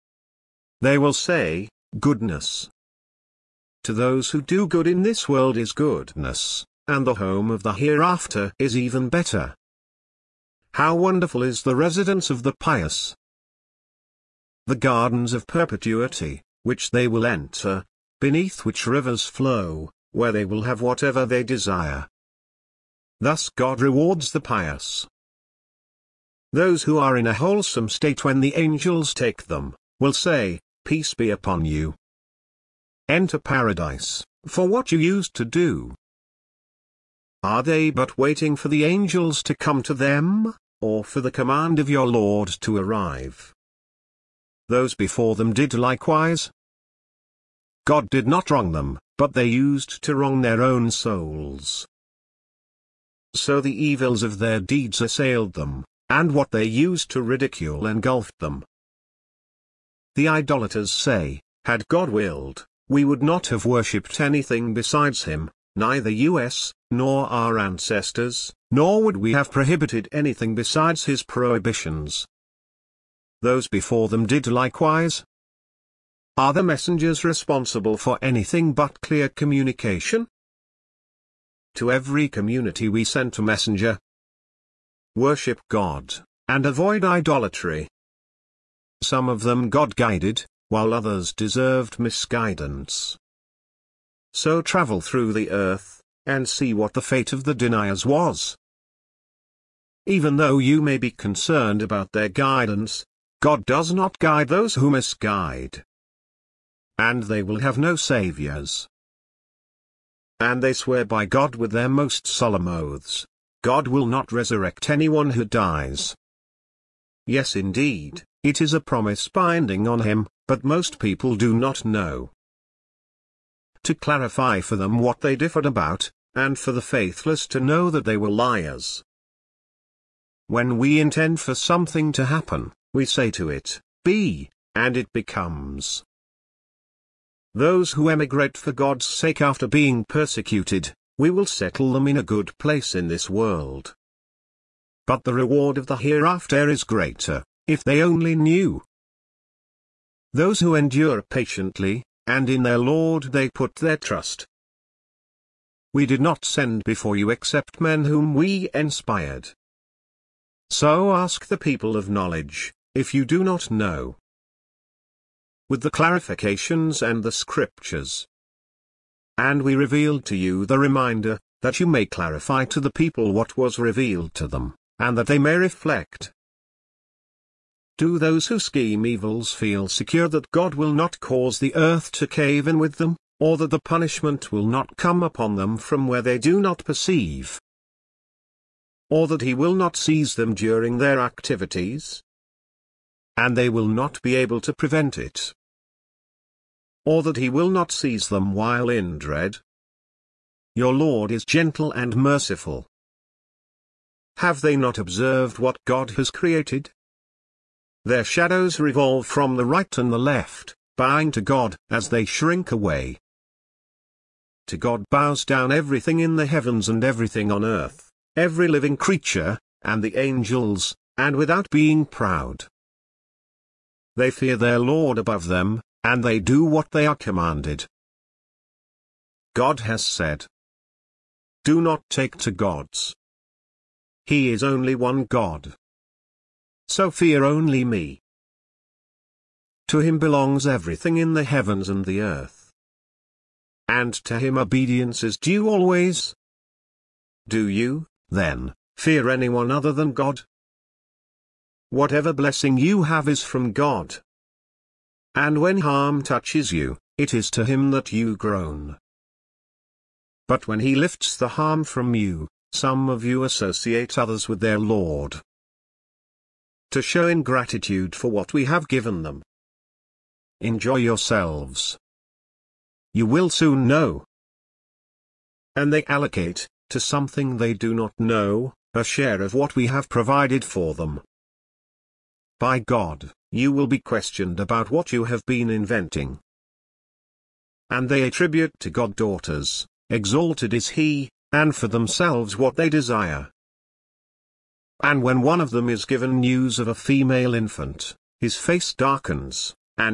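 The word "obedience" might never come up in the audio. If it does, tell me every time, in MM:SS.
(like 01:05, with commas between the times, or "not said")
04:04.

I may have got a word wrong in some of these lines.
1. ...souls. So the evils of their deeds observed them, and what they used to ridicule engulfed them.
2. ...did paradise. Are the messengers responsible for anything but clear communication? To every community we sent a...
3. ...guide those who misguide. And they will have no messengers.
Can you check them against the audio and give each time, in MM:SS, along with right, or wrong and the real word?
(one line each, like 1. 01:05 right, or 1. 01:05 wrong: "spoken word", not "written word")
1. 00:50 wrong: "assailed", not "observed"
2. 01:14 wrong: "likewise", not "paradise"
3. 01:44 wrong: "saviors", not "messengers".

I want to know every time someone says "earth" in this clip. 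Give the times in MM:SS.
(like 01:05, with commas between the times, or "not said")
01:35, 03:01, 03:37, 04:02.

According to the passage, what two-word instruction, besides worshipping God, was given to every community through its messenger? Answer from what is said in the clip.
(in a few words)
Avoid idolatry.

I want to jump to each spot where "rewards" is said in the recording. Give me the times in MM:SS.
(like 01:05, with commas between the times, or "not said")
00:23, 02:25.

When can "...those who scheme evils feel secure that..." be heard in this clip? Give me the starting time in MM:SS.
02:58.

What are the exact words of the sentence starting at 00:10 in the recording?
How wonderful is the residence of the pious!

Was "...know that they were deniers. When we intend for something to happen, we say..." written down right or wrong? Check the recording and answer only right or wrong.
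wrong.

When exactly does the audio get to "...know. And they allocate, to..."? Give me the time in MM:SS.
04:33.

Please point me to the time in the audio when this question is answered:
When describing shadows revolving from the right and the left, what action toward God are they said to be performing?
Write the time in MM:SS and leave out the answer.
03:30.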